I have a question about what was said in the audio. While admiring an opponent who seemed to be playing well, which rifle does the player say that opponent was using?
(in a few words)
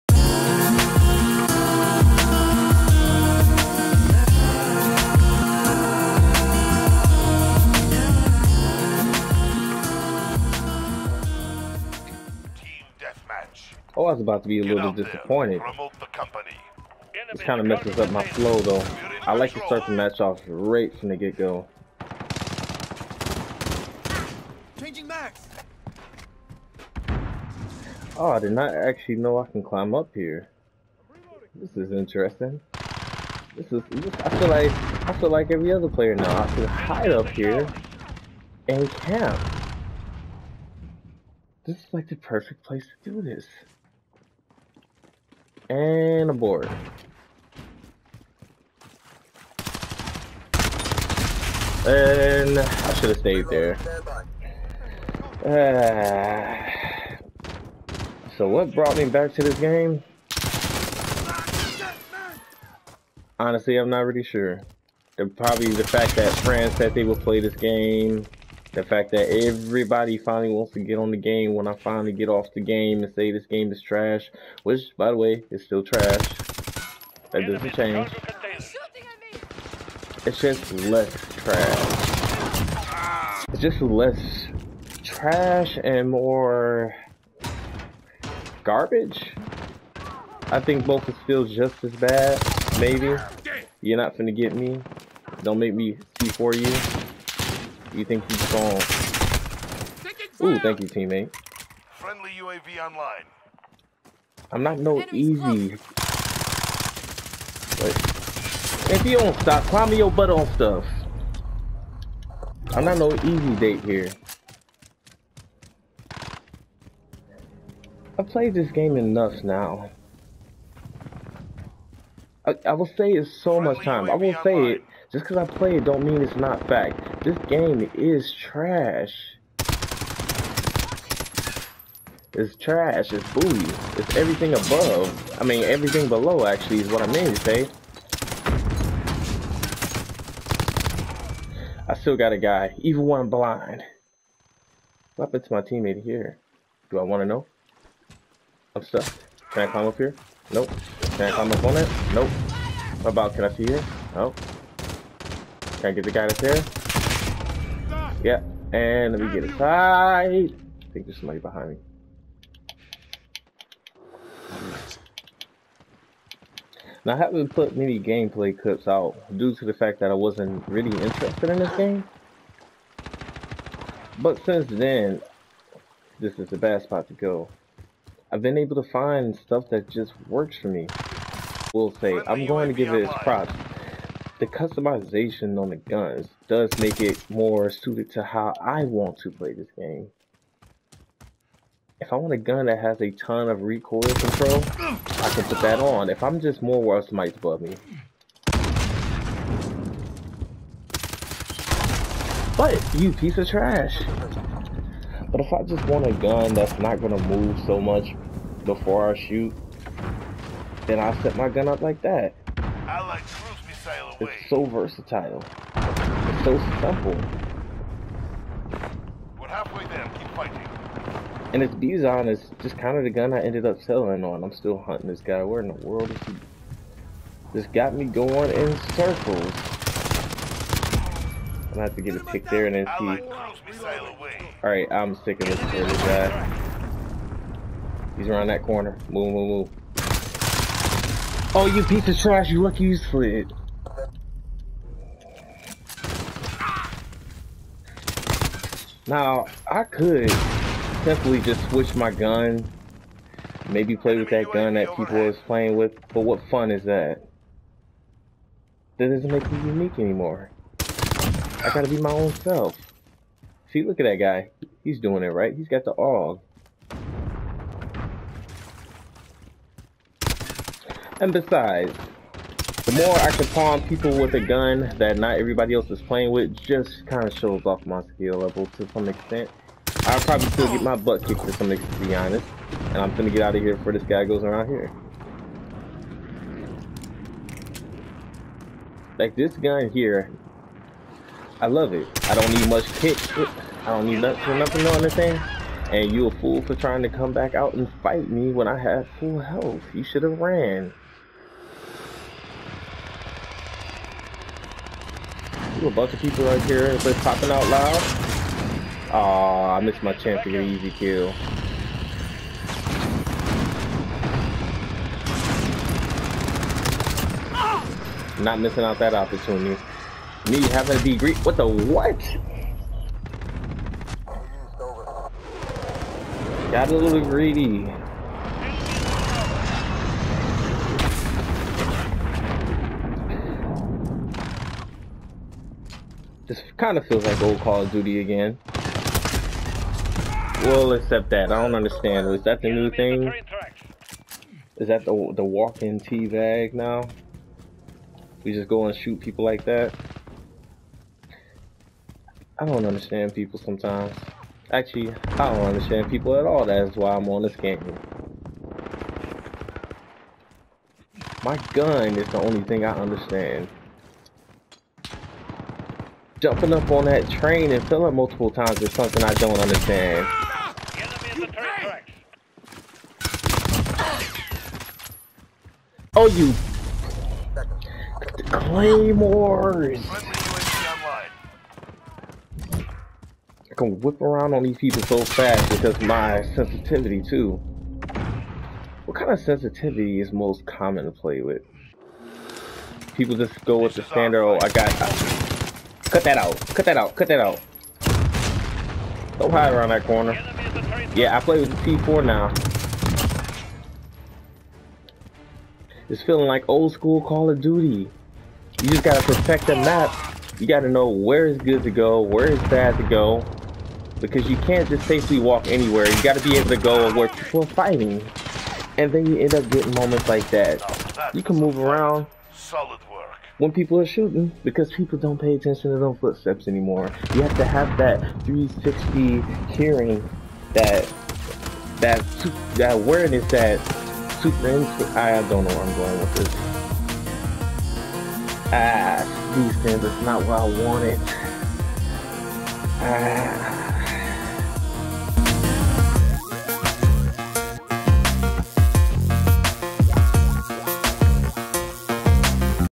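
AUG.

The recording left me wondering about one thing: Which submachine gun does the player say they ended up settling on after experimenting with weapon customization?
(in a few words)
Bizon.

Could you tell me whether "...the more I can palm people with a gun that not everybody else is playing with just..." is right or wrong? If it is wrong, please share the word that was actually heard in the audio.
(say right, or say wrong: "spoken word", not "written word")
right.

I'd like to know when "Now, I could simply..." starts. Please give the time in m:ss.
4:09.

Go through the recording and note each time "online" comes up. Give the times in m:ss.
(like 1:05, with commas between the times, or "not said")
1:42, 2:04.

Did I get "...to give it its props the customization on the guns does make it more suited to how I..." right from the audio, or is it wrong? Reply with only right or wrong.
right.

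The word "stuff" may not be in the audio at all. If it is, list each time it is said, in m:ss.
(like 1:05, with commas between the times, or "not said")
1:50, 2:59.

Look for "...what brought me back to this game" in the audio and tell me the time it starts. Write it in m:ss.
0:58.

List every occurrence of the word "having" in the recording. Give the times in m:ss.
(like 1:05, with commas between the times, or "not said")
5:20.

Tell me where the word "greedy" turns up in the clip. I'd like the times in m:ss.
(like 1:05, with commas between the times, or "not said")
5:21, 5:27.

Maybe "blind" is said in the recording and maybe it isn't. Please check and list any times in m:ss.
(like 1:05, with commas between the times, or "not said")
2:23.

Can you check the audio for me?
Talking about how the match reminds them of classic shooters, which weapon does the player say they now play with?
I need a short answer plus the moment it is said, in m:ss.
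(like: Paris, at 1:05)
P4, at 6:41.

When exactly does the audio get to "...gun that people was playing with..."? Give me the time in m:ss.
4:14.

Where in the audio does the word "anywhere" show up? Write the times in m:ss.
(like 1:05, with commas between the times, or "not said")
6:55.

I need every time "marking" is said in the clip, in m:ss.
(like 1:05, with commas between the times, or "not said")
not said.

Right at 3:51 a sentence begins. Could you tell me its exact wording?
I'm gonna have to get a pick there and then see.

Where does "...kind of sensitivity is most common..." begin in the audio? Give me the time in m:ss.
6:29.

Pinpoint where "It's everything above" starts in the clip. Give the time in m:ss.
2:13.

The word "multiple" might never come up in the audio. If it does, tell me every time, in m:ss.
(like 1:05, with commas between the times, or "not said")
6:08.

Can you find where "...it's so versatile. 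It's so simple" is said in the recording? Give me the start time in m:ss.
3:34.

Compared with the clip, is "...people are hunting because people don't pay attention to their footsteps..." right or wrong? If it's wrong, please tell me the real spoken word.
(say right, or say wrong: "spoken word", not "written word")
wrong: "shooting", not "hunting".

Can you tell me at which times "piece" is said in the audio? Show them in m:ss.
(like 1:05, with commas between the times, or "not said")
3:23, 4:01.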